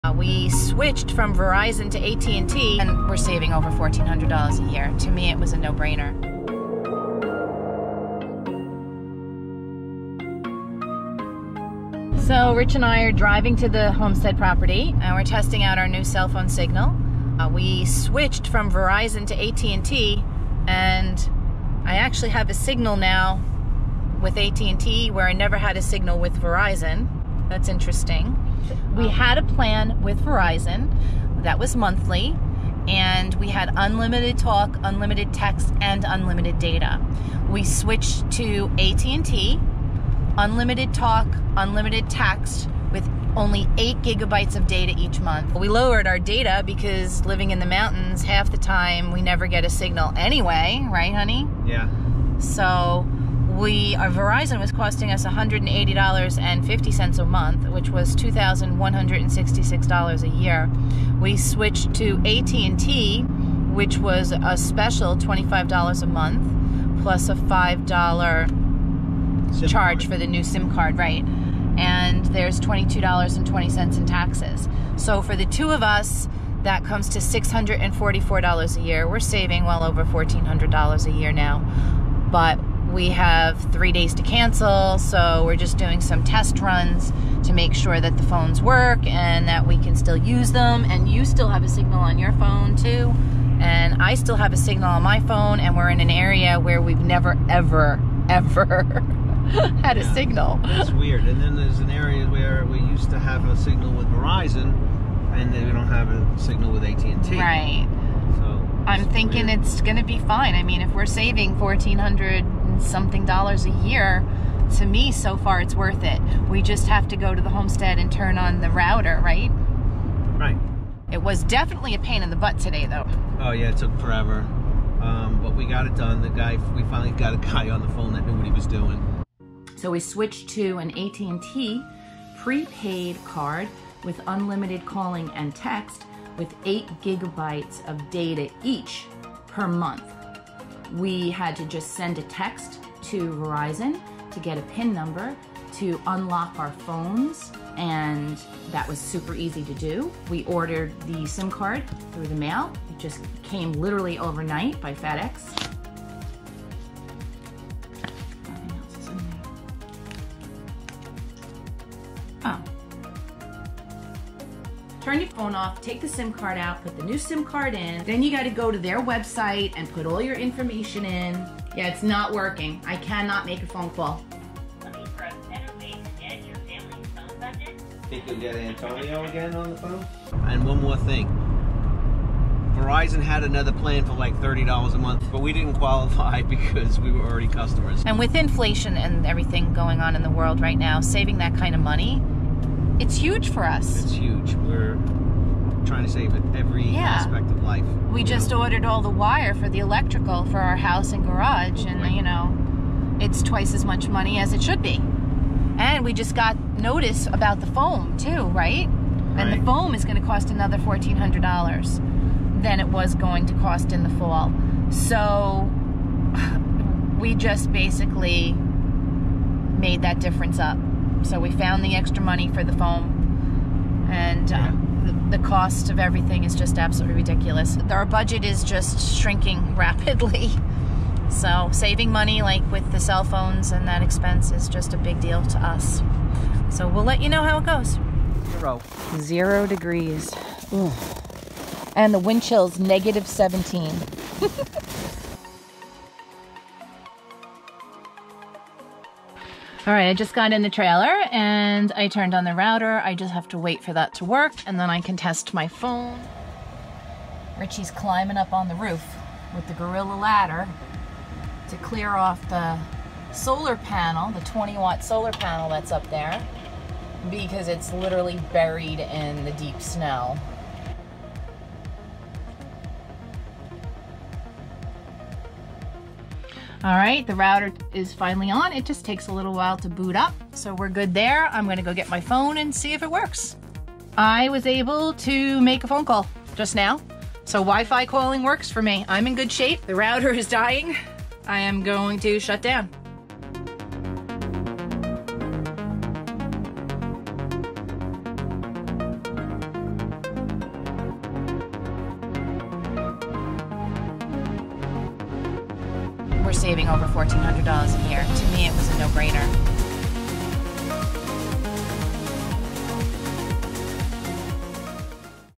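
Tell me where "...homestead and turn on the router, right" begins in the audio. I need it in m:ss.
1:57.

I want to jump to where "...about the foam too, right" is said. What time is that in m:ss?
3:27.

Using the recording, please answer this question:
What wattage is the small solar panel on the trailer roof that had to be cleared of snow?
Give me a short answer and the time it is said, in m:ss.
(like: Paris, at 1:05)
20 watt, at 4:24.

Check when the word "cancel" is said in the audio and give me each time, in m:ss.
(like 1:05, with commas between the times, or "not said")
1:24.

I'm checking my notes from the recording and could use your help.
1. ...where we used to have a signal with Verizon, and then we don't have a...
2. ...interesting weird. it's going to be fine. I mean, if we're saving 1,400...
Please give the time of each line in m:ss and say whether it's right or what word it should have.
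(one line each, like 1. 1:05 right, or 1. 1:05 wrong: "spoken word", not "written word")
1. 1:42 right
2. 1:49 wrong: "thinking", not "interesting".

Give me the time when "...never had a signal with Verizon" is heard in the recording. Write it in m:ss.
0:25.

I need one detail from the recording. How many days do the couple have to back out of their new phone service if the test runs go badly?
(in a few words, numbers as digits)
3.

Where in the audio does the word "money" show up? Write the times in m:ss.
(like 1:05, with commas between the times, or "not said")
3:11, 3:24, 3:42, 3:52.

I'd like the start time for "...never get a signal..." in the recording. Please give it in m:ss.
0:49.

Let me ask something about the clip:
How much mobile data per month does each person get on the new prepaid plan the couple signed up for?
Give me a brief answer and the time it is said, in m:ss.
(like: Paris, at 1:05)
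8 gigabytes, at 0:43.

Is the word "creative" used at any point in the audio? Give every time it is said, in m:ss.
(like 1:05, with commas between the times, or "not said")
not said.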